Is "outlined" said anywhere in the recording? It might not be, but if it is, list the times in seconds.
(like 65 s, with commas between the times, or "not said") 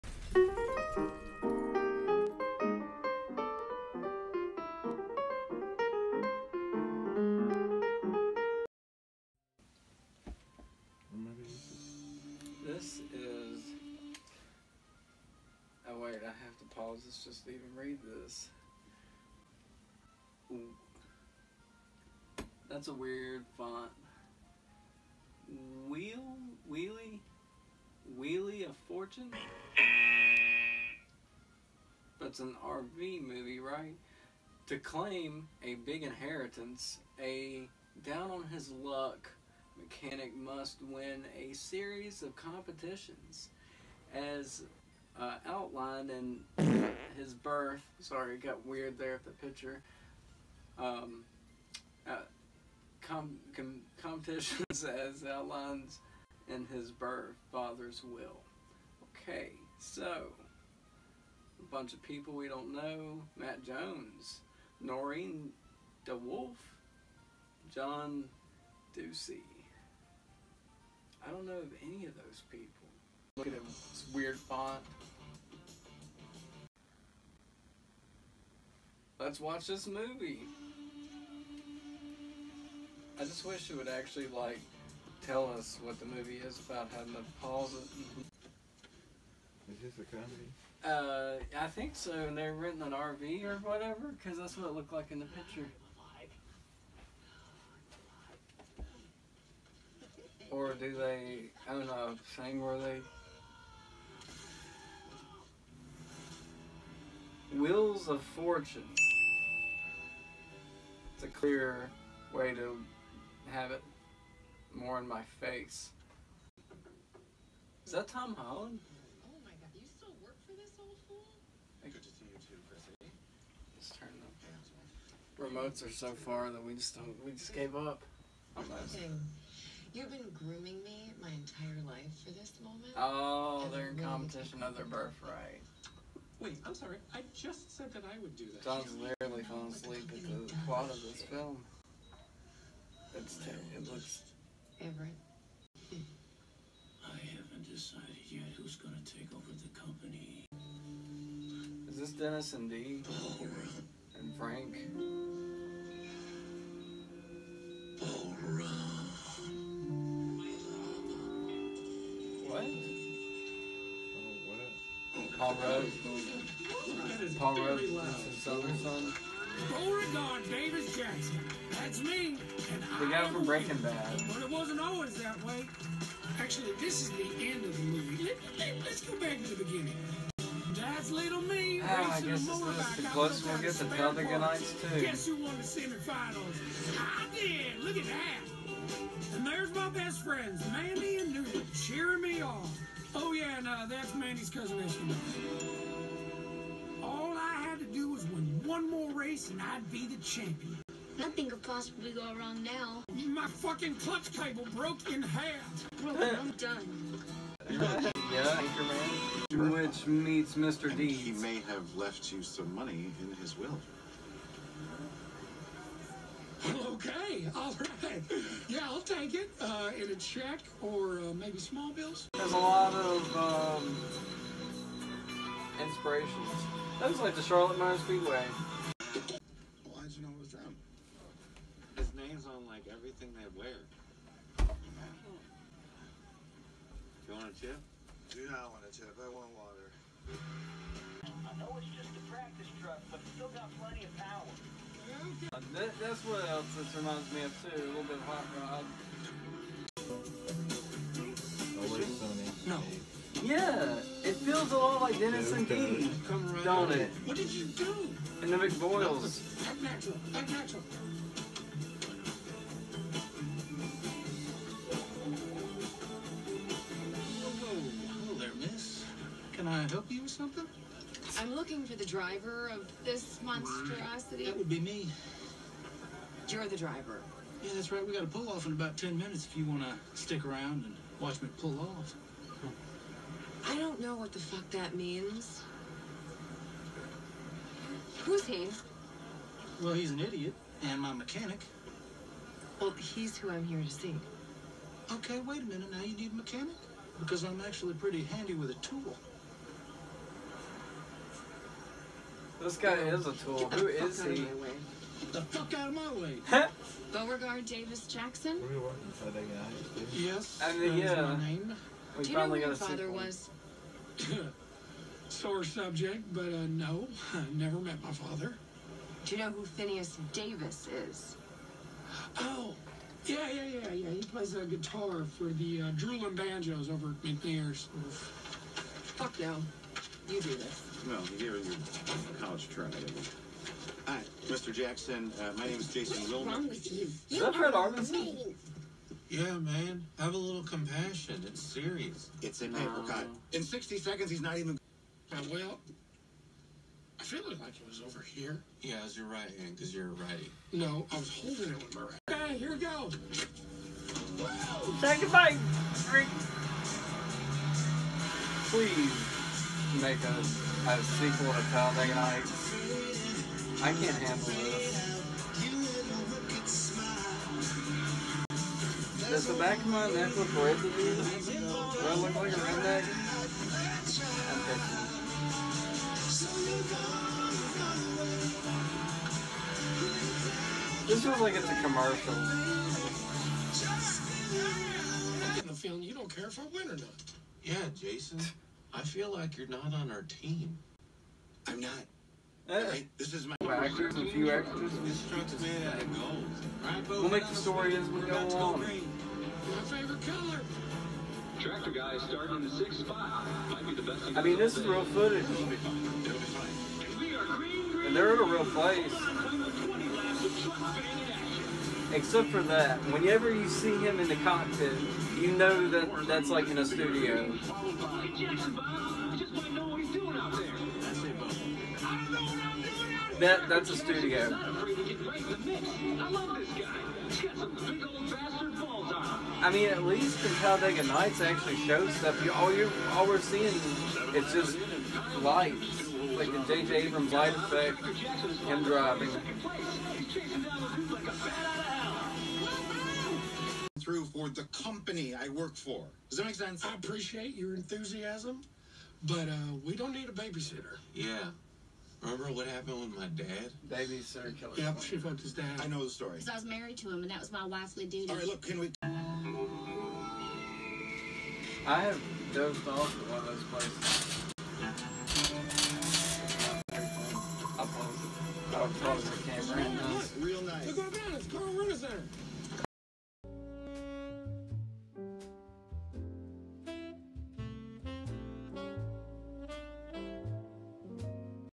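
45 s, 55 s.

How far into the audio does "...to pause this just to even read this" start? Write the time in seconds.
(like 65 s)
16 s.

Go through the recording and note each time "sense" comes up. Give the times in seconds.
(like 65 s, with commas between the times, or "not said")
446 s.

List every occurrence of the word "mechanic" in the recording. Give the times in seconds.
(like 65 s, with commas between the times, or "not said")
39 s, 291 s, 296 s.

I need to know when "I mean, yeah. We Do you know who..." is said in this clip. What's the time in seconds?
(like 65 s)
310 s.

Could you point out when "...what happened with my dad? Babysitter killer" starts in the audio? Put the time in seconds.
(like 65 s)
452 s.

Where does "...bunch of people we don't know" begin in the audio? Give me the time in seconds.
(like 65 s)
61 s.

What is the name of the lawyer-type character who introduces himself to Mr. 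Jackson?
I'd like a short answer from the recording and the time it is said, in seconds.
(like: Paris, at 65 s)
Jason Wilmer, at 335 s.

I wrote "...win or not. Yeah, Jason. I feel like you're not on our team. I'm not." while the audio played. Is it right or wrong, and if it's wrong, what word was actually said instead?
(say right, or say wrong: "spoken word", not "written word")
right.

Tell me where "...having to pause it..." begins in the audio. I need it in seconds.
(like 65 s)
86 s.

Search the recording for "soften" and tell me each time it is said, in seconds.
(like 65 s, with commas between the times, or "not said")
not said.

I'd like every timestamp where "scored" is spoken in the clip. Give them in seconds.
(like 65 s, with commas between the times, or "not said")
not said.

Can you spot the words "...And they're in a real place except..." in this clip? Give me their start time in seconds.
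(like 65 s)
408 s.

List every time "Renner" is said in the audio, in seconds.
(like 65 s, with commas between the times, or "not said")
471 s.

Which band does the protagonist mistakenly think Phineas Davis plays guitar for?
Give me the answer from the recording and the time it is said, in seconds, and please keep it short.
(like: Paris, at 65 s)
Droolin' Banjos, at 325 s.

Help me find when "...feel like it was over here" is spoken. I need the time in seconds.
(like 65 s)
347 s.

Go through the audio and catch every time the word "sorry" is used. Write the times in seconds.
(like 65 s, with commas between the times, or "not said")
47 s, 136 s.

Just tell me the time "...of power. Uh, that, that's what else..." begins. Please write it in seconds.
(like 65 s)
244 s.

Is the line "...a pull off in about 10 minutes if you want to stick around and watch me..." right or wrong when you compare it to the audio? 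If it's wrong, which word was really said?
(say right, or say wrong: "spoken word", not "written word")
right.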